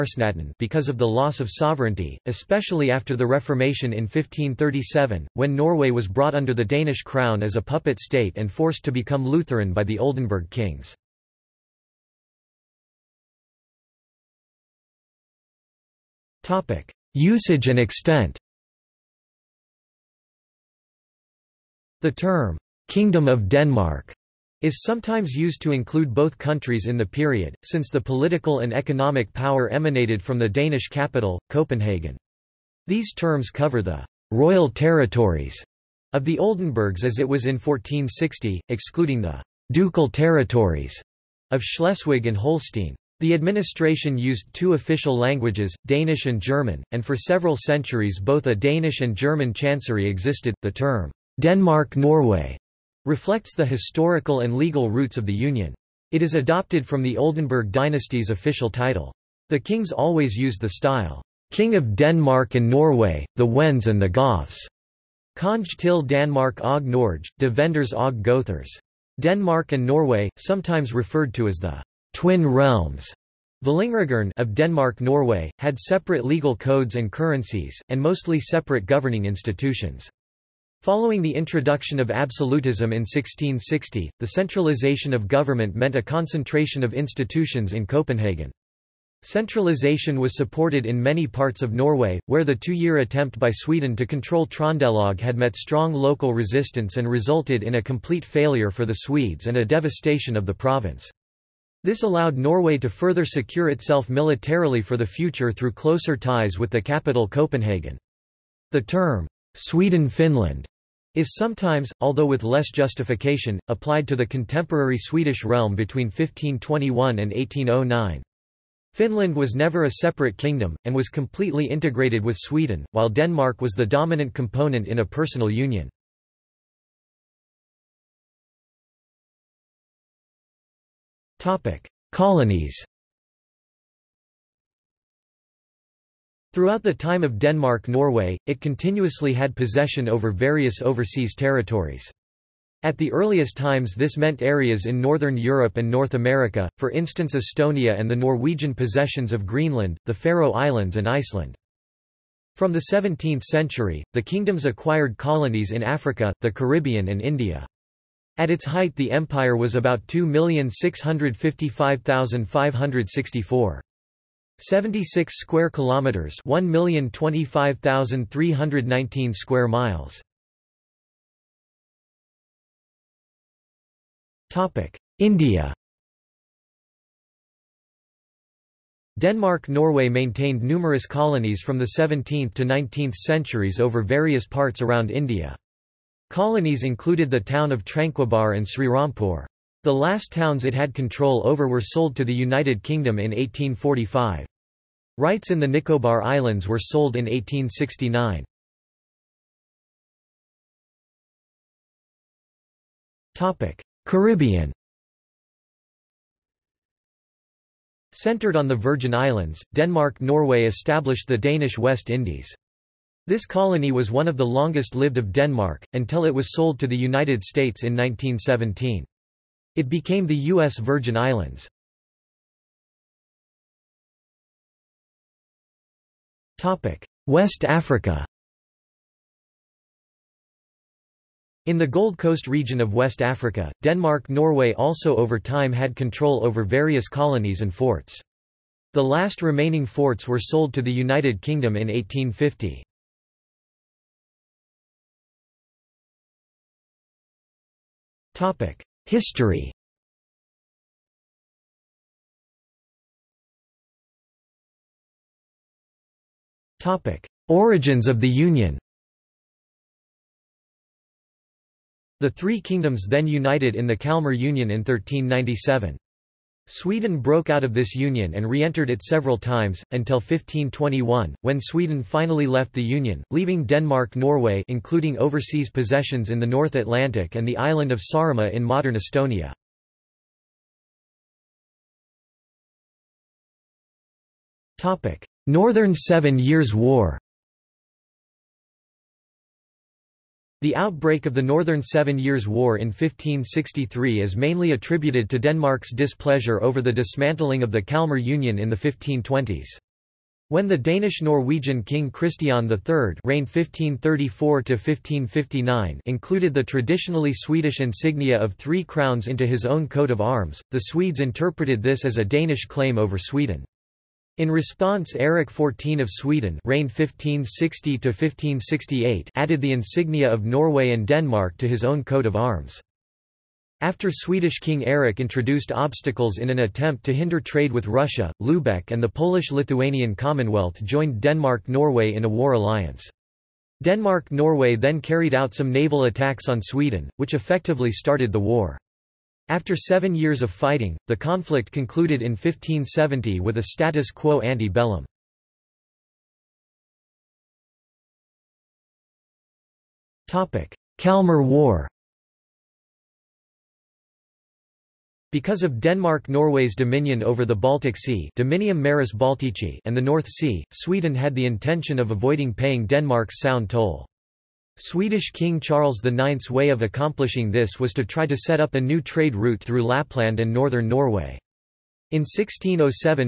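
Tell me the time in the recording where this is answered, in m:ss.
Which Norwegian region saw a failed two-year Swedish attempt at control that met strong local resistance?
1:34.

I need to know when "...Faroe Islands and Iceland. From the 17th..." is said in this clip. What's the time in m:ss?
2:30.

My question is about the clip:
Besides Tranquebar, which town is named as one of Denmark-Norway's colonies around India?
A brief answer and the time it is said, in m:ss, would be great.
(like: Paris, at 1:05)
Srirampur, at 3:08.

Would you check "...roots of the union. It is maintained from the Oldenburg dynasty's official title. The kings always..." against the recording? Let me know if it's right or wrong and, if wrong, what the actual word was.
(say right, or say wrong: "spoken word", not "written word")
wrong: "adopted", not "maintained".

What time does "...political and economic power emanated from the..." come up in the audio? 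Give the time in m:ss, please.
0:27.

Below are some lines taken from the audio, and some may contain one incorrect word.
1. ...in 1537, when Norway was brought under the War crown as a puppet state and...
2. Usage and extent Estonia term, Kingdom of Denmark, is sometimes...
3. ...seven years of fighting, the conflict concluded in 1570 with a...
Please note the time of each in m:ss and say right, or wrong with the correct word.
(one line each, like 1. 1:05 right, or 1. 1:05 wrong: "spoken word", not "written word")
1. 0:03 wrong: "Danish", not "War"
2. 0:17 wrong: "The", not "Estonia"
3. 5:39 right.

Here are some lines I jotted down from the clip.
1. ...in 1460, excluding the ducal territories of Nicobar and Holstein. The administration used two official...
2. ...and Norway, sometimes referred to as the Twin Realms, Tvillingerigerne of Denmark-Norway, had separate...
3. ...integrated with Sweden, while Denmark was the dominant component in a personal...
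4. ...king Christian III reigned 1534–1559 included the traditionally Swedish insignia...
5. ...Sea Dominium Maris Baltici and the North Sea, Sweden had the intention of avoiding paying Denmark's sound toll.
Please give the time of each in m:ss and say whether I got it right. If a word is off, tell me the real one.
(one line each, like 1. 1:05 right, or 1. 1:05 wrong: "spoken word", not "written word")
1. 0:37 wrong: "Schleswig", not "Nicobar"
2. 1:09 right
3. 2:01 right
4. 5:01 right
5. 5:57 right.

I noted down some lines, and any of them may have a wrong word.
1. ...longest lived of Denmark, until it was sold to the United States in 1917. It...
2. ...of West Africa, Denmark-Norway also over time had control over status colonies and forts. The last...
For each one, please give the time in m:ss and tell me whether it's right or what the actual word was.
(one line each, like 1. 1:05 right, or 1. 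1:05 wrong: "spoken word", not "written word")
1. 3:34 right
2. 3:52 wrong: "various", not "status".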